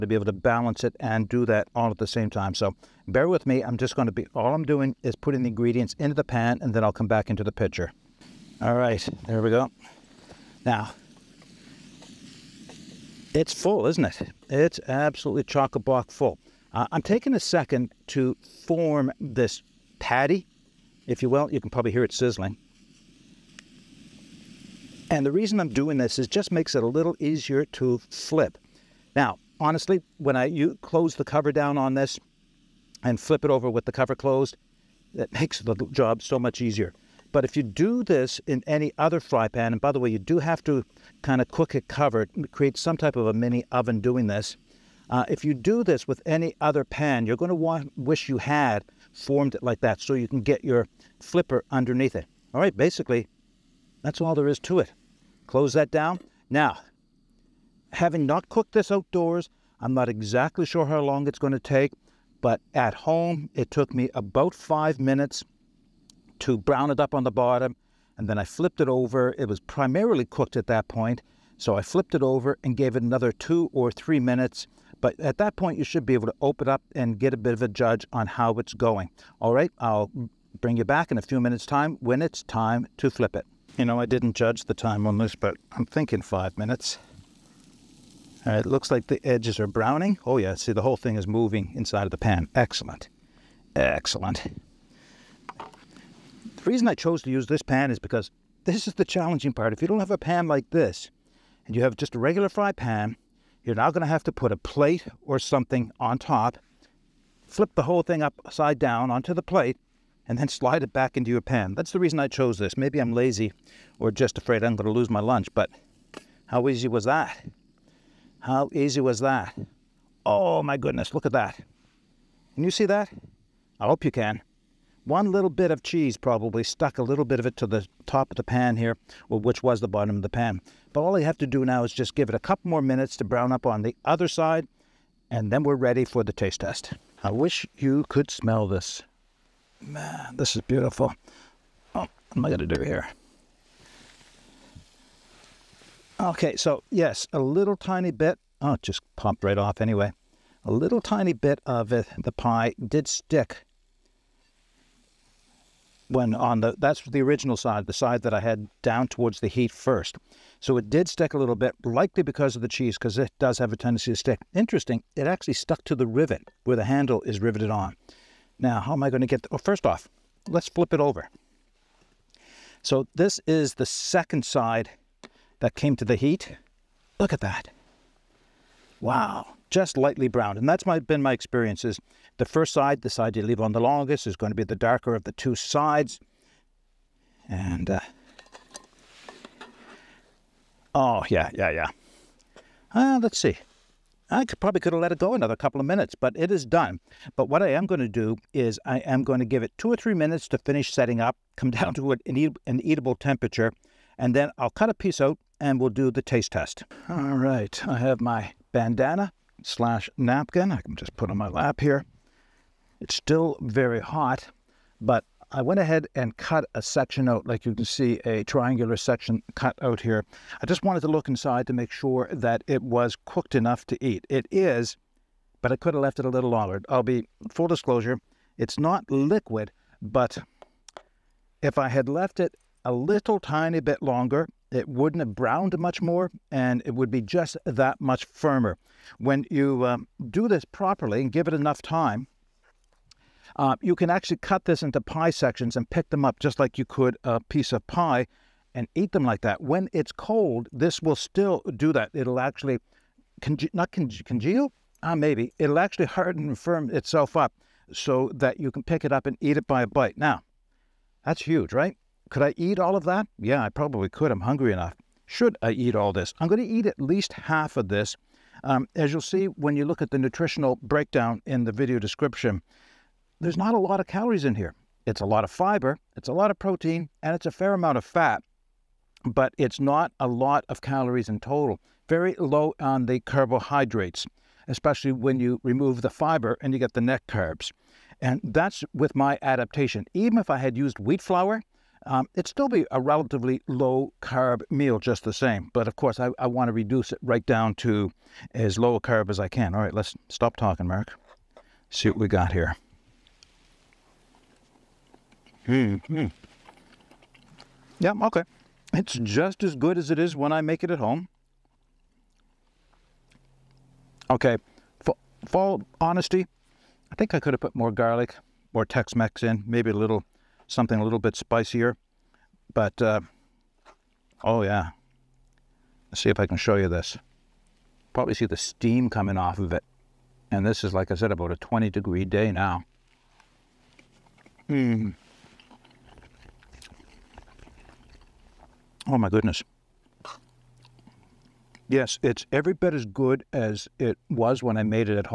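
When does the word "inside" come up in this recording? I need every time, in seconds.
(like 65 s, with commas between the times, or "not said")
91 s, 221 s.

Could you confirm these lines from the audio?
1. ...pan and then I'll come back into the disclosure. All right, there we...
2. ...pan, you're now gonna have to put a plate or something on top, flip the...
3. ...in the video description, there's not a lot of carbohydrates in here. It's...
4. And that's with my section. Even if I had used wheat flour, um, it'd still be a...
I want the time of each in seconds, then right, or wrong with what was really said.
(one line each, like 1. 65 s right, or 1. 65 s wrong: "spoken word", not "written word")
1. 6 s wrong: "picture", not "disclosure"
2. 102 s right
3. 271 s wrong: "calories", not "carbohydrates"
4. 288 s wrong: "adaptation", not "section".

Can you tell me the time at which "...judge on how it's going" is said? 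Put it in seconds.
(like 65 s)
77 s.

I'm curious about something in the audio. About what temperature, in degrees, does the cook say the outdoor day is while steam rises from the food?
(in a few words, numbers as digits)
20 degrees.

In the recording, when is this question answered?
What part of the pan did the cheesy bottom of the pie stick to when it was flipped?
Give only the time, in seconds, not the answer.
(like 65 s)
165 s.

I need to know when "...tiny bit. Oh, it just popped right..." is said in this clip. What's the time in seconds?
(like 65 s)
147 s.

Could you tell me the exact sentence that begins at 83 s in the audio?
You know, I didn't judge the time on this, but I'm thinking five minutes.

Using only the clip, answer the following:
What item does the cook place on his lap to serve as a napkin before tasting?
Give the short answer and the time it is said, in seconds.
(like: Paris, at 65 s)
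bandana, at 208 s.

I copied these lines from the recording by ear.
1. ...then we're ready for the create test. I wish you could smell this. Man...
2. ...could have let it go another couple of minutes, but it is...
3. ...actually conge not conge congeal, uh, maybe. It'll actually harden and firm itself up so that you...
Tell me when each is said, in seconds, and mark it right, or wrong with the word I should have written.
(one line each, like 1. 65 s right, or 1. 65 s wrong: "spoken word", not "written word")
1. 135 s wrong: "taste", not "create"
2. 194 s right
3. 252 s right.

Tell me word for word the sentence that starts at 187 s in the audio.
And, uh, oh, yeah, yeah, yeah.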